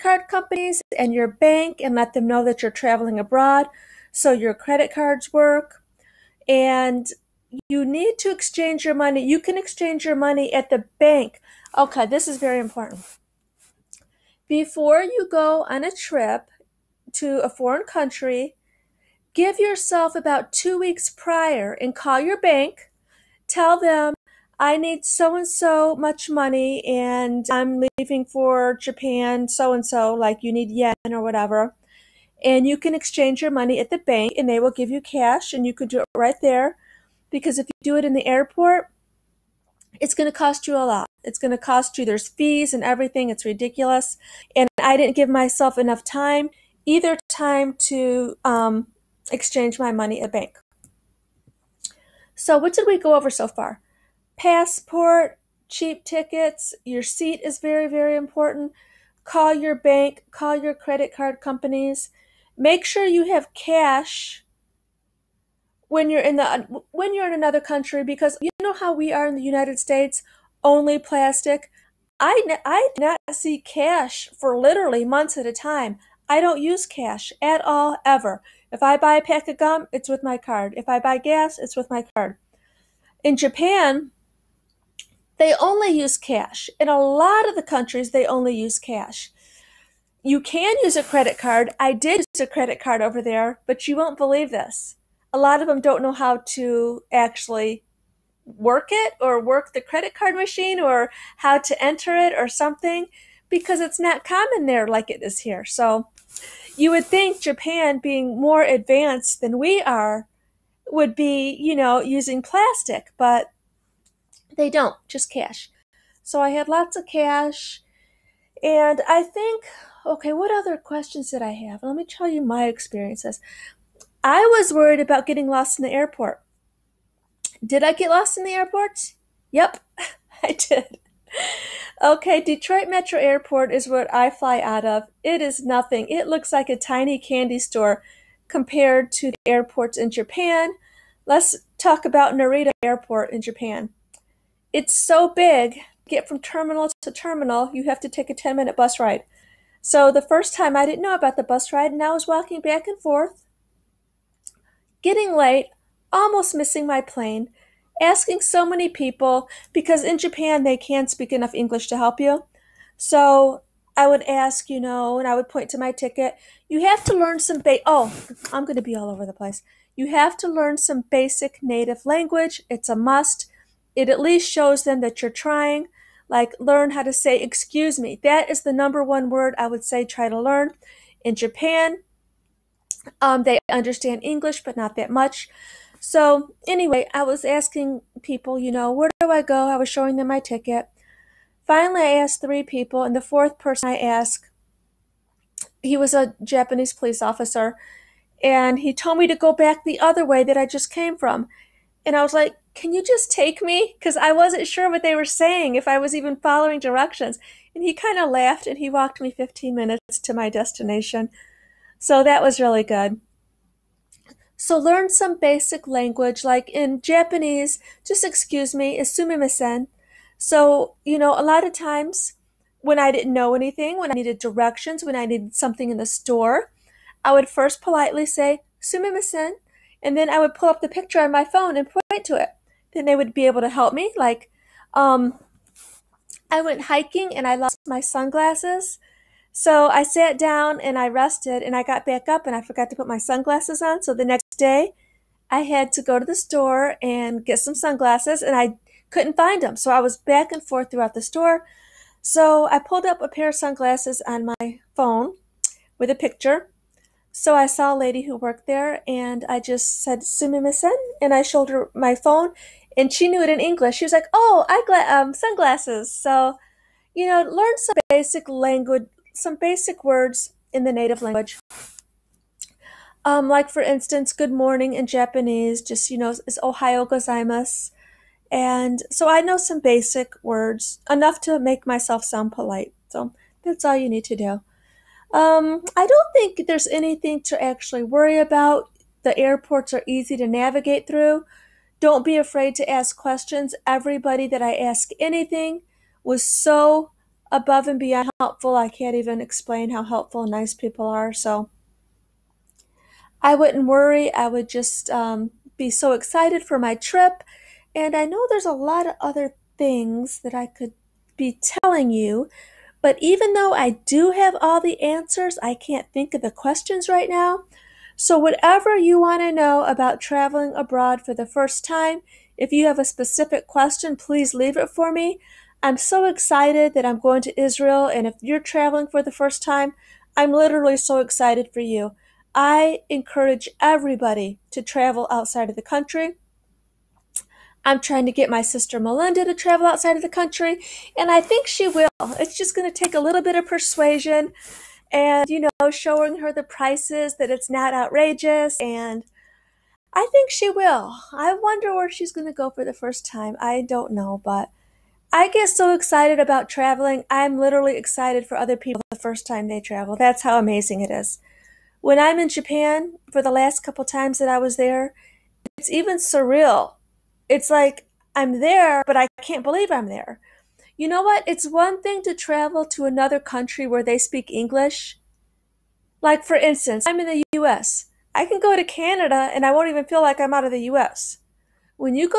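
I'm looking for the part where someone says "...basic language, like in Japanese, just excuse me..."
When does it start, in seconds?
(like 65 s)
215 s.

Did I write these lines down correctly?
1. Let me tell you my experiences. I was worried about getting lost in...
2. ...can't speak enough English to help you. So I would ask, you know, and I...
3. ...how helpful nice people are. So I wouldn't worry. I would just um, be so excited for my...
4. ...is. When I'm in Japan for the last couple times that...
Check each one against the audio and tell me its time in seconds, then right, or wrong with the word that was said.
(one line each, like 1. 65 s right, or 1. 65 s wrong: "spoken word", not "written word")
1. 121 s right
2. 160 s right
3. 299 s right
4. 361 s right.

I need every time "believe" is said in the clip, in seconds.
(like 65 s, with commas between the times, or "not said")
94 s, 369 s.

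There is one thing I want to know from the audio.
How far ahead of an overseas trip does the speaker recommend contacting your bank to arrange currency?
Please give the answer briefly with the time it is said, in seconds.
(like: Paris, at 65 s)
2 weeks, at 20 s.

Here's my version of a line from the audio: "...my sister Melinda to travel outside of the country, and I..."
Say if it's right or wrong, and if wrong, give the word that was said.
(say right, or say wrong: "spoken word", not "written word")
right.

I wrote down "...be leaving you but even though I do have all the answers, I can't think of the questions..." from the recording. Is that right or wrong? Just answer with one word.
wrong.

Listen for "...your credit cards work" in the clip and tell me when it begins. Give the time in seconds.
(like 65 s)
4 s.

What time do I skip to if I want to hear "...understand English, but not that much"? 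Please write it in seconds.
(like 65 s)
183 s.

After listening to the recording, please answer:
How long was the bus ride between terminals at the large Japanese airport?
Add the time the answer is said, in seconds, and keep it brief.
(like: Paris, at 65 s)
10 minutes, at 148 s.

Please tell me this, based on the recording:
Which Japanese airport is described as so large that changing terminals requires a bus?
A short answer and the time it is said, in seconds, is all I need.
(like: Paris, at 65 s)
Narita Airport, at 142 s.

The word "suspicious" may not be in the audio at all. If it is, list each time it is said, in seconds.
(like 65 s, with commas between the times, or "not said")
not said.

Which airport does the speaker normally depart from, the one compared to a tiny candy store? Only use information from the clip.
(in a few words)
Detroit Metro Airport.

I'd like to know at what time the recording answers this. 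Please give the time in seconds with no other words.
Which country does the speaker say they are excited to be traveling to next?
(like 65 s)
327 s.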